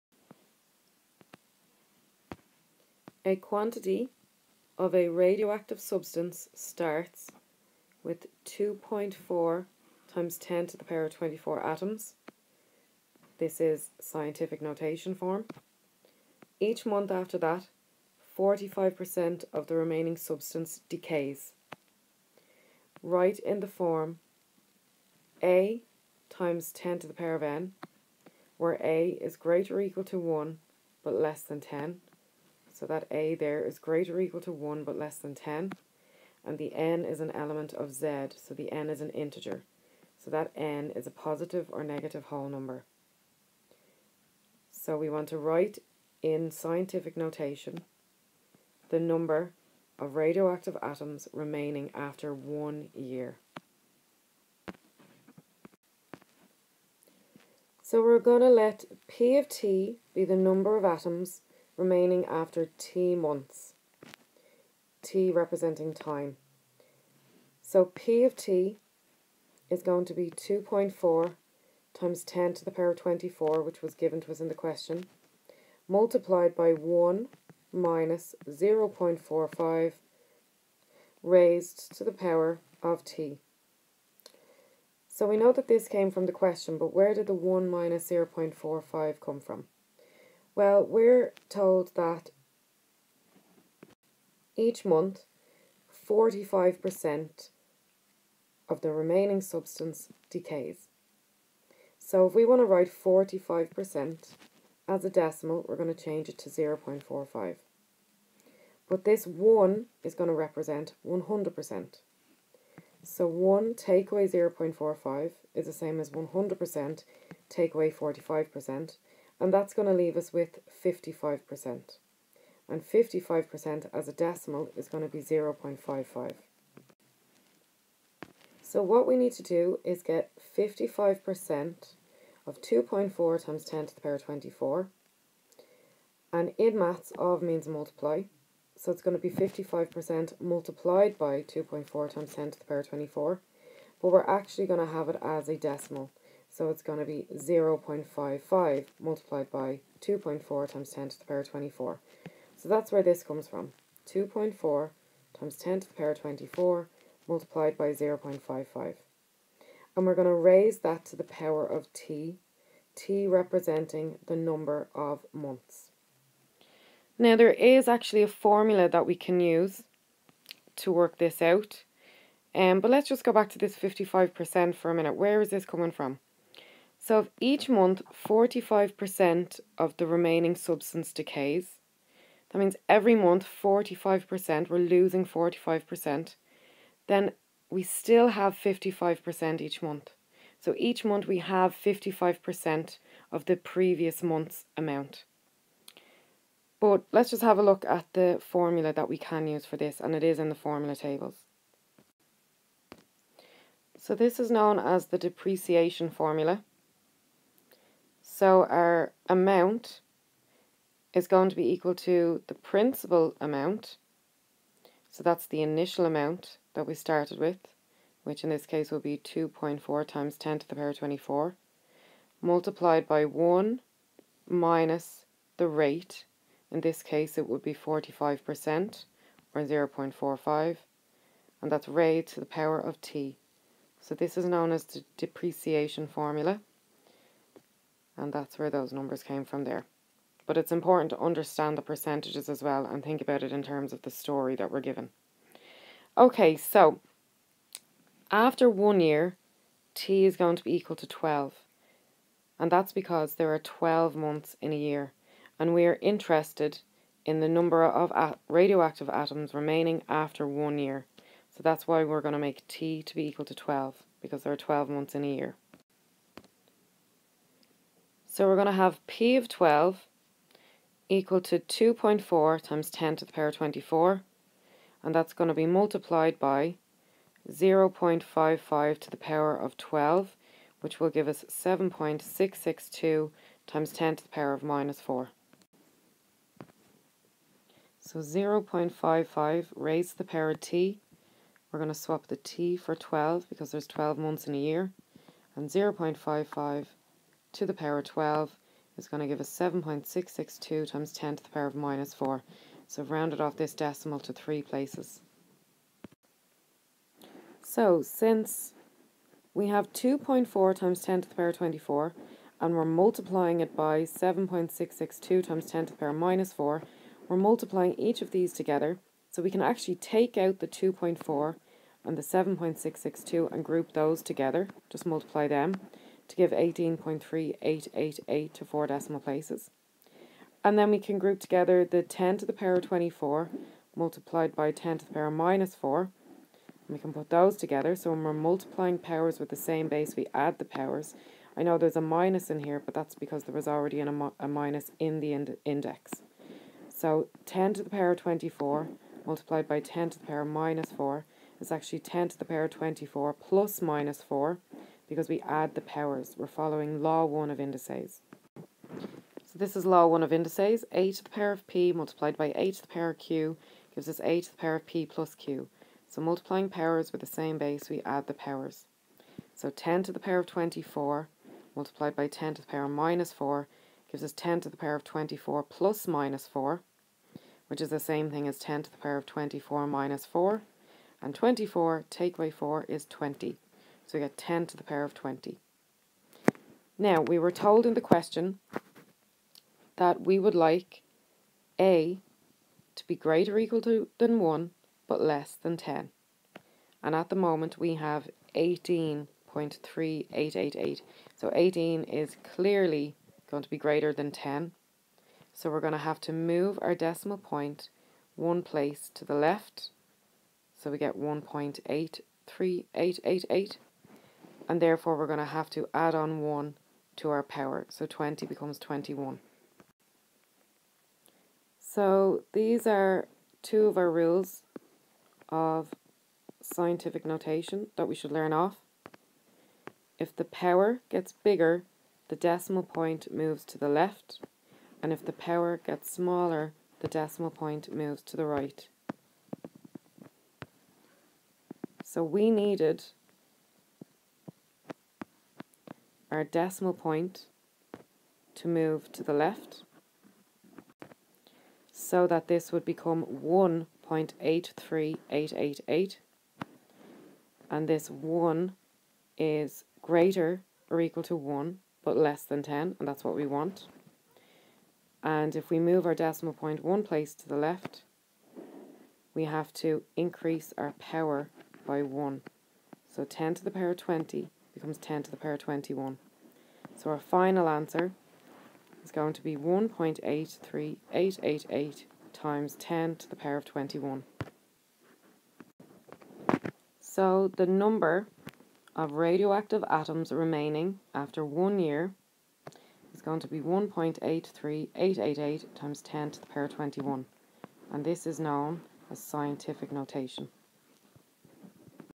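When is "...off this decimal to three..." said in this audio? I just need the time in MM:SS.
05:03.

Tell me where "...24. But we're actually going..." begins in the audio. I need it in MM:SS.
02:22.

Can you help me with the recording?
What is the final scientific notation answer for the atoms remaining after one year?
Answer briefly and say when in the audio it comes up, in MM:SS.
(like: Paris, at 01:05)
1.83888 × 10^21, at 07:59.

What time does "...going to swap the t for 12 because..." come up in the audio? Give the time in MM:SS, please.
04:51.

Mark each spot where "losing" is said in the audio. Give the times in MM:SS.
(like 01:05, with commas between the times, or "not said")
03:04.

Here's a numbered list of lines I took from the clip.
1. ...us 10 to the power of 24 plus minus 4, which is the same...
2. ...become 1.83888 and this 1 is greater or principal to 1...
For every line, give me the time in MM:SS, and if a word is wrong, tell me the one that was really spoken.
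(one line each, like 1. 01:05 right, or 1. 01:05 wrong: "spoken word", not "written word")
1. 06:14 right
2. 07:32 wrong: "equal", not "principal".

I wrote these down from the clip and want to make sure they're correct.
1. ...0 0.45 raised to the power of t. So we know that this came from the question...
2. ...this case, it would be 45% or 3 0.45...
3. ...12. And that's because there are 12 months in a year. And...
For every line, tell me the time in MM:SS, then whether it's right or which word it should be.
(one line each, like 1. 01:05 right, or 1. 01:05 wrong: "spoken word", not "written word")
1. 01:18 right
2. 03:46 wrong: "0", not "3"
3. 04:11 right.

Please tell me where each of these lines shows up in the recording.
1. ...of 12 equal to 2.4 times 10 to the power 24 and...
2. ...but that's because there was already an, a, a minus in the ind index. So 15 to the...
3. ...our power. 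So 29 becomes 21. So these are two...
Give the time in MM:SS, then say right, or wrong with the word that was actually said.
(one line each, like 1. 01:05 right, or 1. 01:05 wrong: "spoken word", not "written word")
1. 04:29 right
2. 05:42 wrong: "10", not "15"
3. 06:57 wrong: "20", not "29".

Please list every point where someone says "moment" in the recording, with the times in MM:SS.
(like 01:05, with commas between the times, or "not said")
06:37.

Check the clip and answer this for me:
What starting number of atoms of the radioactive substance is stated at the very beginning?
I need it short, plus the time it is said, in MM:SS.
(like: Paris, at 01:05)
2.4 × 10^24, at 00:08.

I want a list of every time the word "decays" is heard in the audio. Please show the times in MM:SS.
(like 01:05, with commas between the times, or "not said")
00:20, 01:40, 03:01.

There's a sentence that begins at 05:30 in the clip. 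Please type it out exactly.
And then we can group together the 10 to the power of 24 multiplied by 10 to the power of minus 4.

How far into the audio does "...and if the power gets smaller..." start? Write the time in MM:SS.
07:15.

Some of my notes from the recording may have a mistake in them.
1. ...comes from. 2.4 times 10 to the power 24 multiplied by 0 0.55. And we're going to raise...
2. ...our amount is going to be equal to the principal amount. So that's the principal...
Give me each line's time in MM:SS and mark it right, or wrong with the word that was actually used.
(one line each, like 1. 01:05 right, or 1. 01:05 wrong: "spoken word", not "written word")
1. 02:33 right
2. 03:28 wrong: "initial", not "principal".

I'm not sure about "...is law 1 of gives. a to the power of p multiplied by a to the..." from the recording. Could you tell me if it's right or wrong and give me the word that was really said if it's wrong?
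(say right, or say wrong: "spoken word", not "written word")
wrong: "indices", not "gives".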